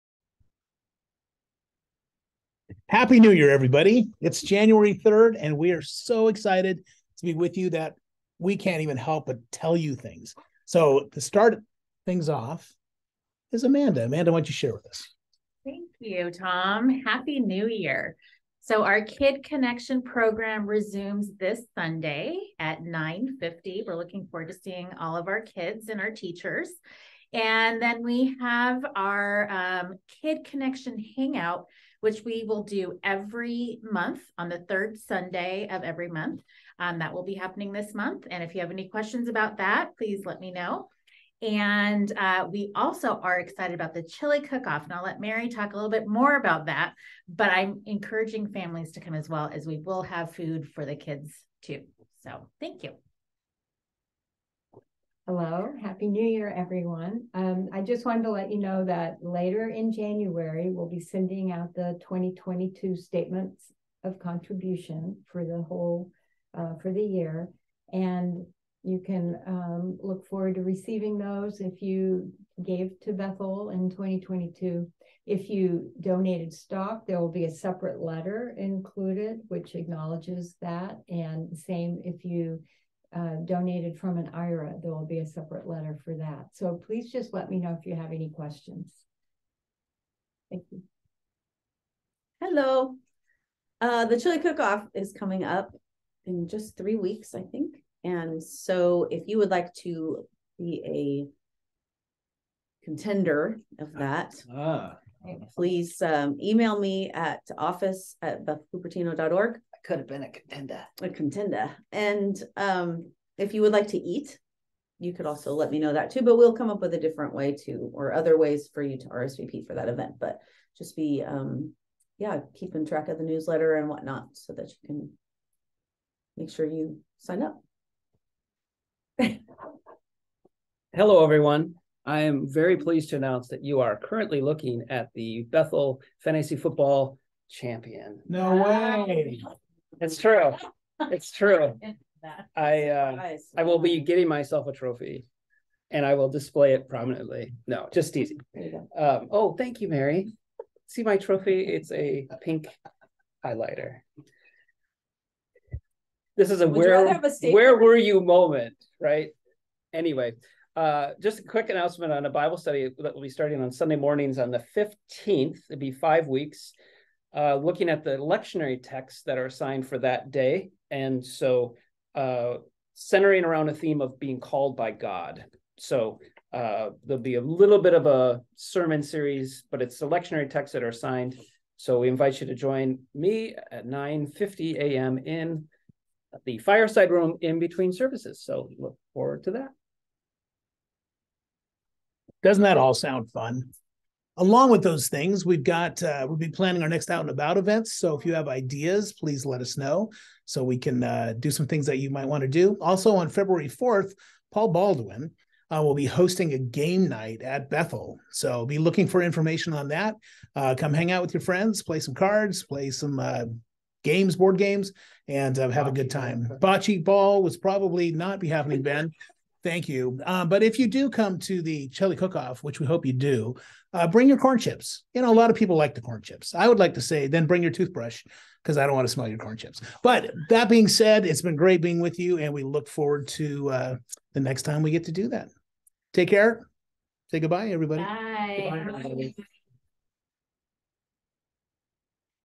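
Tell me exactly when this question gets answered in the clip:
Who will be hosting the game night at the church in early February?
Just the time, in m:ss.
3:24.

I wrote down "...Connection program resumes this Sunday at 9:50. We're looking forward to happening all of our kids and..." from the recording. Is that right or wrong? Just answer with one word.
wrong.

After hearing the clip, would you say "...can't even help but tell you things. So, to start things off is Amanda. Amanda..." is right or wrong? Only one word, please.
right.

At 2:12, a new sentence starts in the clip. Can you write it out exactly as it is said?
I am very pleased to announce that you are currently looking at the Bethel Fantasy Football Champion.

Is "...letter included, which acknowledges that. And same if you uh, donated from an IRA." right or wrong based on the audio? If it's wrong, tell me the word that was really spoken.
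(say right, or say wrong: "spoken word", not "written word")
right.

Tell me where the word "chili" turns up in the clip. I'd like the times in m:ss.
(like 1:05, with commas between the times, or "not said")
0:44, 1:34, 3:41.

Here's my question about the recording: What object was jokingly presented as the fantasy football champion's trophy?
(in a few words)
A pink highlighter.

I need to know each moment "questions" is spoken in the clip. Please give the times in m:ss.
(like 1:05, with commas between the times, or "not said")
0:38, 1:28.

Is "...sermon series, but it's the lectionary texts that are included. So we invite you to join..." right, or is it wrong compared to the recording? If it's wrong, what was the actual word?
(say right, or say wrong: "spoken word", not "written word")
wrong: "assigned", not "included".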